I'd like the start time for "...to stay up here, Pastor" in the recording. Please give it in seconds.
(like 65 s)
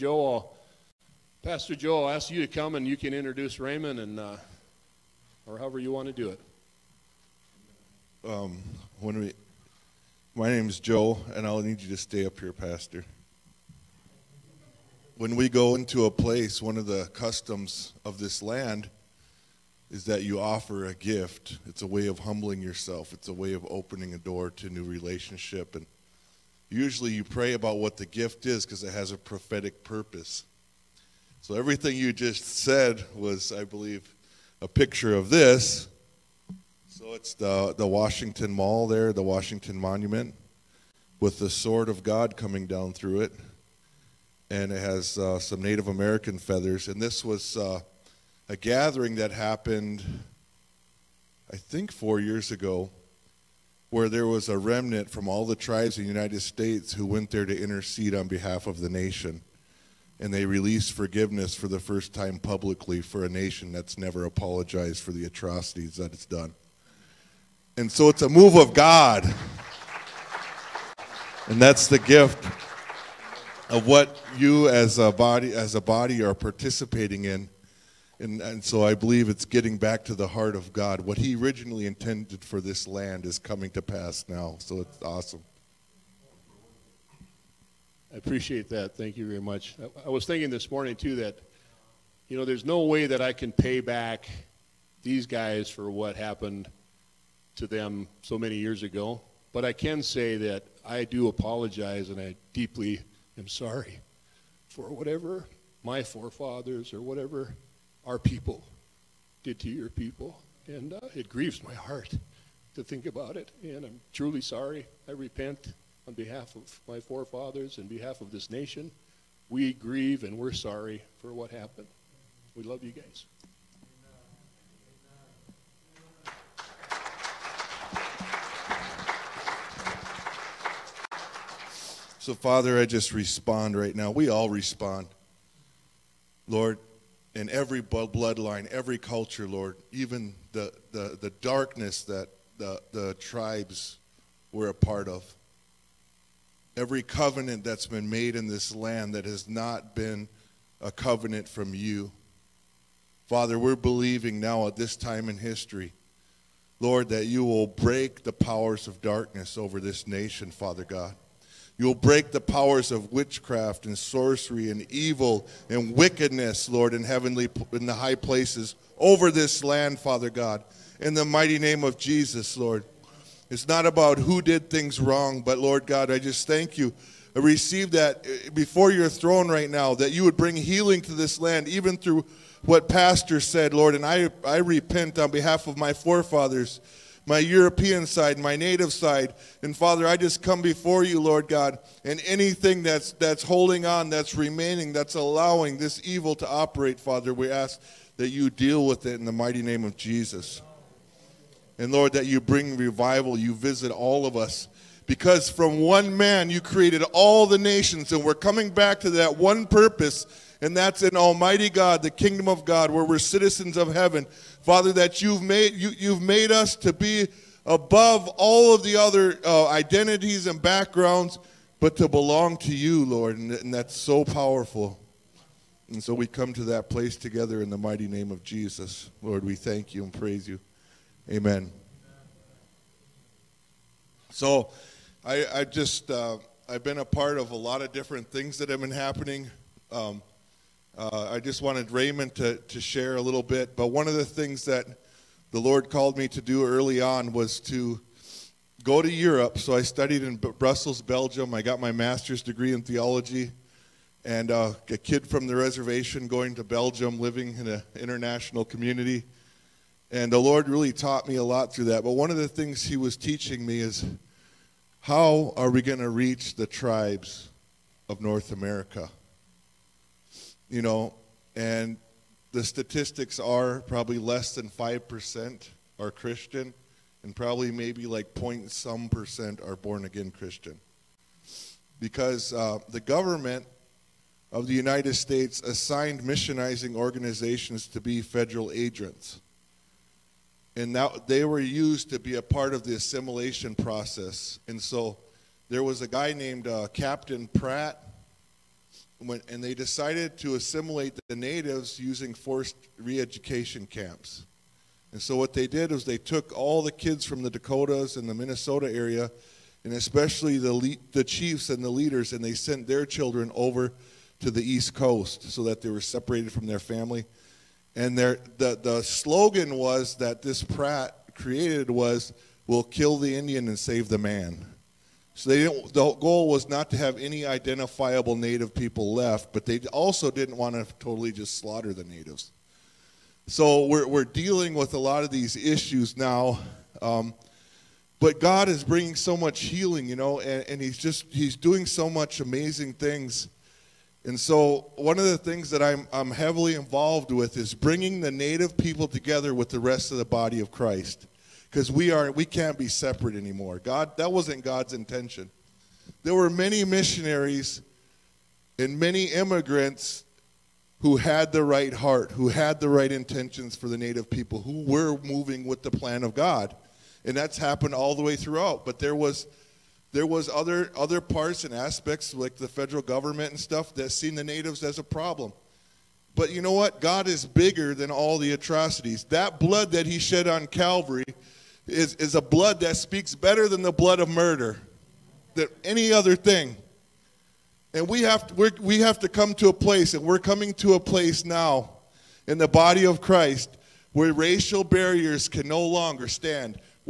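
11 s.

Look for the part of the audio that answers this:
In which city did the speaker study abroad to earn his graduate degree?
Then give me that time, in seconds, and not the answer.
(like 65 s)
250 s.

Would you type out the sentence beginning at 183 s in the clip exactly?
And I, I repent on behalf of my forefathers my European side, my native side.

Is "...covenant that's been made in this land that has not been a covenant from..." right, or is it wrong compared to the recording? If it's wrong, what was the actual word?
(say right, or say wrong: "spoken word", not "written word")
right.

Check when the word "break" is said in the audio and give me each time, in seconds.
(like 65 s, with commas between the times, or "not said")
157 s, 161 s.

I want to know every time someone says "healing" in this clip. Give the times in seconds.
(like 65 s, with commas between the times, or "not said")
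180 s, 339 s.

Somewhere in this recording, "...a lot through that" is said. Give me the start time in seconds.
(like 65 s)
261 s.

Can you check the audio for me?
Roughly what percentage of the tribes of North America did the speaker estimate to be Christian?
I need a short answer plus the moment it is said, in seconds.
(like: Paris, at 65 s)
less than 5%, at 274 s.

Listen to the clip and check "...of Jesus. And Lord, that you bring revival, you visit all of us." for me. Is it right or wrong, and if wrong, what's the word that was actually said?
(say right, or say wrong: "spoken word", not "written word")
right.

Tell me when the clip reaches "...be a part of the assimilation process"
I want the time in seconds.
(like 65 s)
292 s.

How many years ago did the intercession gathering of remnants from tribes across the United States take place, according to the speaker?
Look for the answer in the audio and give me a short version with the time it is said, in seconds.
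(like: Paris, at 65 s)
4, at 51 s.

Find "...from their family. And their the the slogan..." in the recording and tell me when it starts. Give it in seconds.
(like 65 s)
316 s.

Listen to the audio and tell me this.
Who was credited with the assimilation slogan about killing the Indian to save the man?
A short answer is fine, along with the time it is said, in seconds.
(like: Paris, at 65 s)
Captain Pratt, at 296 s.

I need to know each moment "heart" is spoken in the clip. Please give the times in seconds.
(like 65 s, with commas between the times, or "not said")
80 s, 111 s, 361 s.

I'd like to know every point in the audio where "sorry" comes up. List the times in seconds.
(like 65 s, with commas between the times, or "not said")
103 s, 114 s, 120 s.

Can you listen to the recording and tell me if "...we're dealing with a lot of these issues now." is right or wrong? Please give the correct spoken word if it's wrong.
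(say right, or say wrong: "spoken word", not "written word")
right.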